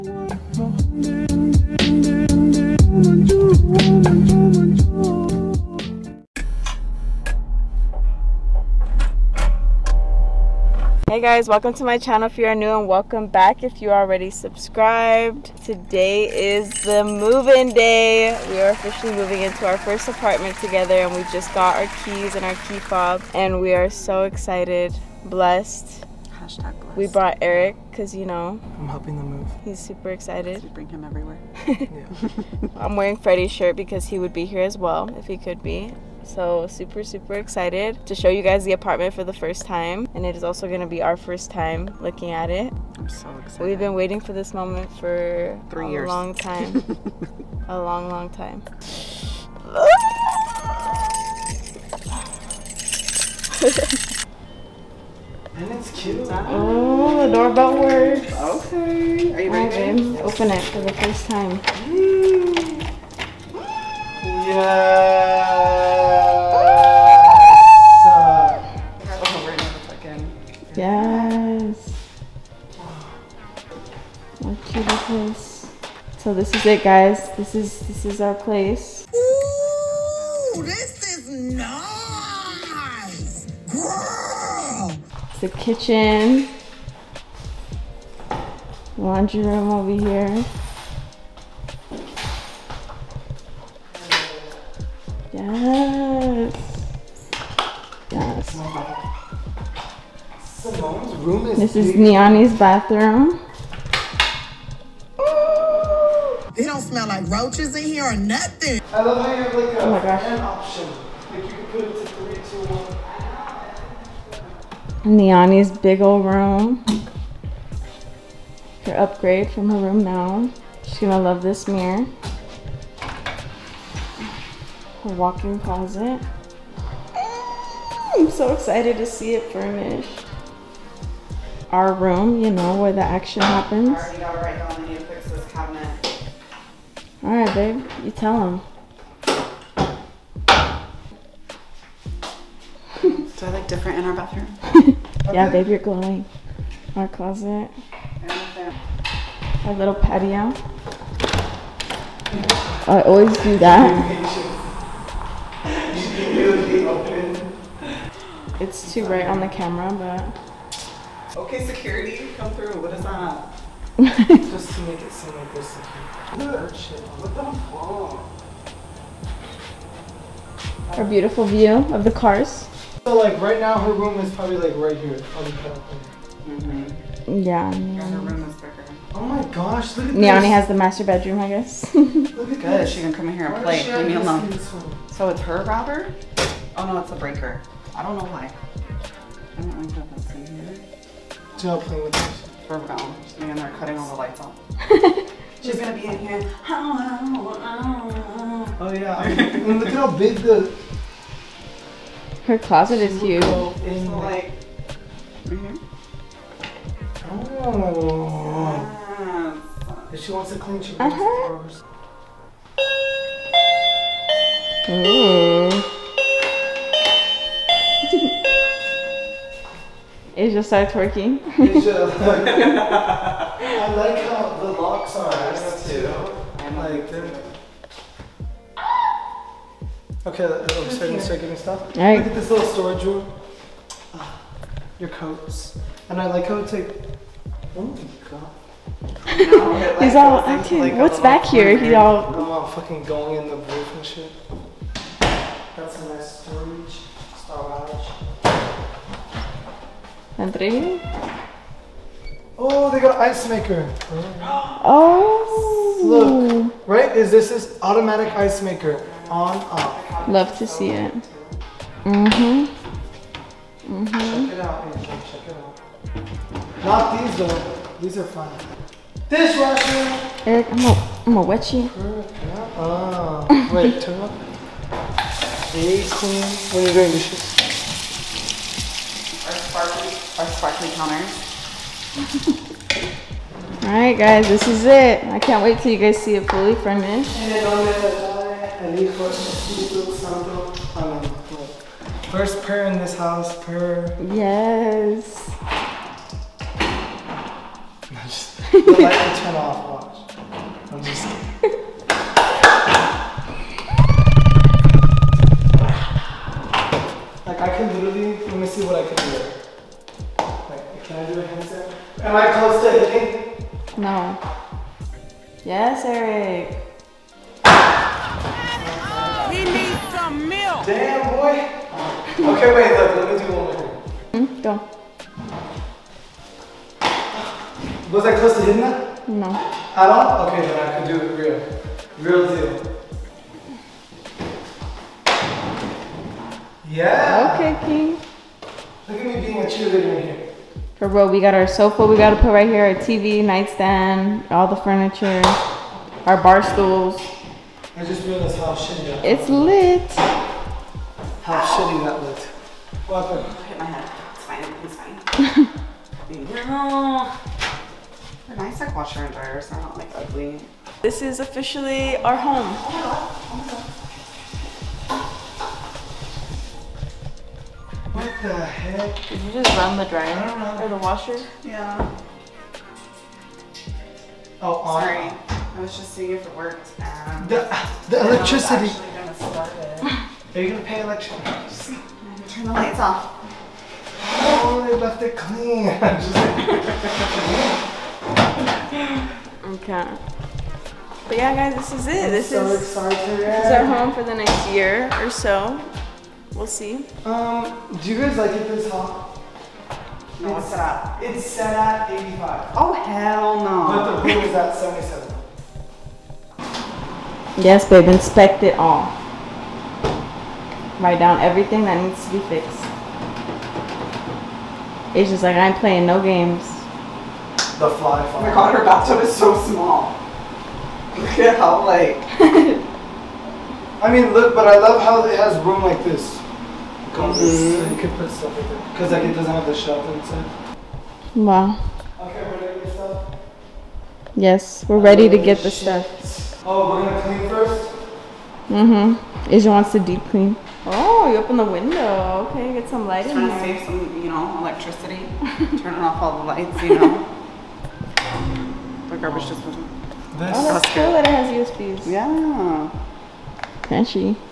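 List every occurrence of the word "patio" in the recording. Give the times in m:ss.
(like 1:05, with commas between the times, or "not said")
2:29.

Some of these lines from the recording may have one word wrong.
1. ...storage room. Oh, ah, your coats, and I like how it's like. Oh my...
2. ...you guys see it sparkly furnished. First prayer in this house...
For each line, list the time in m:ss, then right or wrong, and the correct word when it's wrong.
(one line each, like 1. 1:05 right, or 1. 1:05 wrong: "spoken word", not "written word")
1. 3:52 right
2. 4:45 wrong: "fully", not "sparkly".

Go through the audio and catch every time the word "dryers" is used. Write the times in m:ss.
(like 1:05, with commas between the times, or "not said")
5:59, 6:10.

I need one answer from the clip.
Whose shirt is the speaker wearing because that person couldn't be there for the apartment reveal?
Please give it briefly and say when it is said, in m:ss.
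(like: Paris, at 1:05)
Freddie, at 0:33.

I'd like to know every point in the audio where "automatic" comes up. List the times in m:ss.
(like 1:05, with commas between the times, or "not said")
4:17.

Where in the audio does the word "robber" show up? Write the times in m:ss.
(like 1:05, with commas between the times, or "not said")
3:05.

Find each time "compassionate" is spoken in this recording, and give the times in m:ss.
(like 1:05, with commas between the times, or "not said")
not said.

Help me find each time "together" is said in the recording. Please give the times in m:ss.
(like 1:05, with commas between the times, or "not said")
0:20.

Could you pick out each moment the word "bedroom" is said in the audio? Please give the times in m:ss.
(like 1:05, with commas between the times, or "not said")
3:01.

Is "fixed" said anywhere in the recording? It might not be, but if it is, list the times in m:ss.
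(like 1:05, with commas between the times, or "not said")
6:52.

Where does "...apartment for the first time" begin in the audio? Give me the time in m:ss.
0:38.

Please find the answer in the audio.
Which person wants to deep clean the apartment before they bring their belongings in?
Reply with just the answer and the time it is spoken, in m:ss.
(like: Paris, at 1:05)
Asia, at 7:19.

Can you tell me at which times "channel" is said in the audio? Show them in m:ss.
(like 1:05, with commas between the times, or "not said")
0:11.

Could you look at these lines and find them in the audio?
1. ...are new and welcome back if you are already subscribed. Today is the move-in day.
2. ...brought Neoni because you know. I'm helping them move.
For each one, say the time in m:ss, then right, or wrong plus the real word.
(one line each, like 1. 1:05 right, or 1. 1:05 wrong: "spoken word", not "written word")
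1. 0:12 right
2. 0:27 wrong: "Eric", not "Neoni".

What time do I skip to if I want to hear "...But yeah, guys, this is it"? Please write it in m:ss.
6:31.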